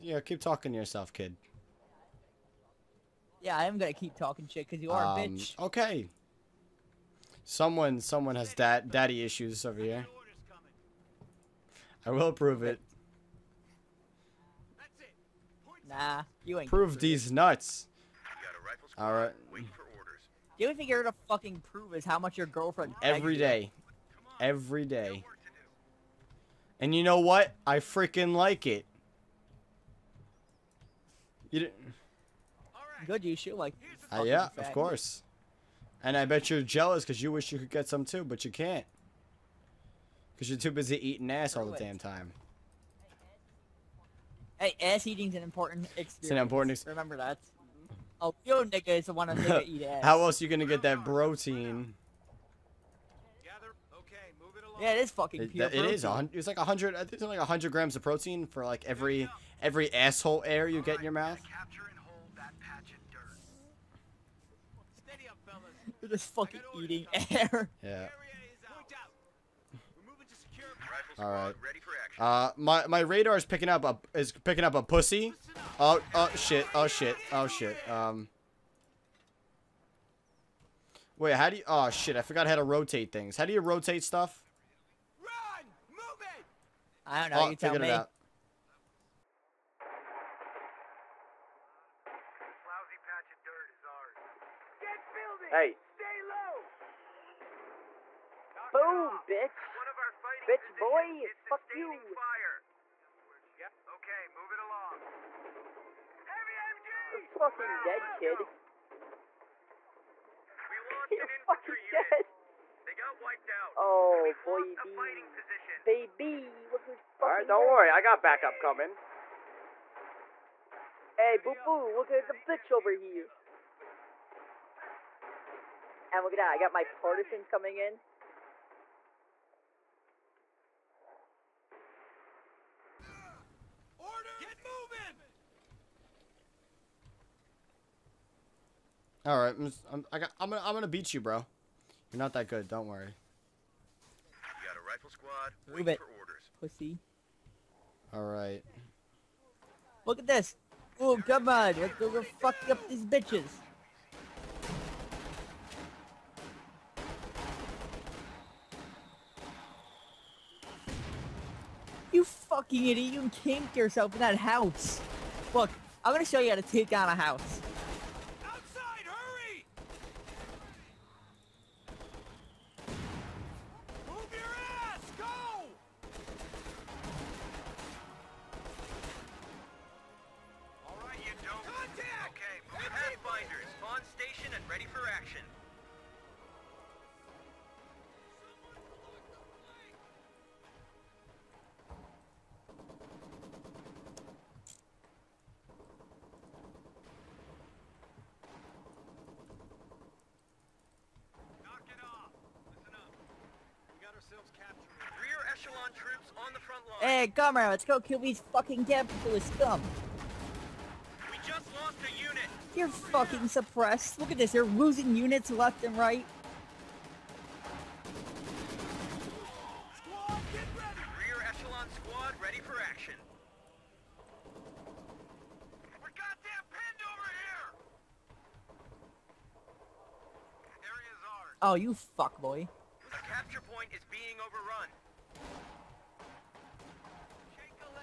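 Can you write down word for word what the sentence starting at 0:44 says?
Hey, ass eating's an important experience.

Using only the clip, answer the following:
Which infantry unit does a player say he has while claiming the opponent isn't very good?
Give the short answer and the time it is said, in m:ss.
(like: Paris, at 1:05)
rifle squad, at 2:24.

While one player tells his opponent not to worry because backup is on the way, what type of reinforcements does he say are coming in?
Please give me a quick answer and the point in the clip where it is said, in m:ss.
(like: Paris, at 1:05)
partisans, at 2:06.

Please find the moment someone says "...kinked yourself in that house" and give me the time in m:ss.
2:43.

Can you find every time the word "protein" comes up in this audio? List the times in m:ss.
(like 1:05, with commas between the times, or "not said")
0:51, 0:58.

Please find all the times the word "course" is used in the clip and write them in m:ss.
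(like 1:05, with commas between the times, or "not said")
0:34.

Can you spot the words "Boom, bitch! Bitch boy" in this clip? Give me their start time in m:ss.
1:38.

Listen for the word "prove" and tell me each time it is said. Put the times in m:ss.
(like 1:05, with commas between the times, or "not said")
0:12, 0:16, 0:21.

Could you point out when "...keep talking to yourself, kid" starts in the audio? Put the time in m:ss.
0:00.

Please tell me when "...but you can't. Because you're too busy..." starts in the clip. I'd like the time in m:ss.
0:38.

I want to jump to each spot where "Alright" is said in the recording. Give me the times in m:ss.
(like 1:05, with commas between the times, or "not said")
1:57.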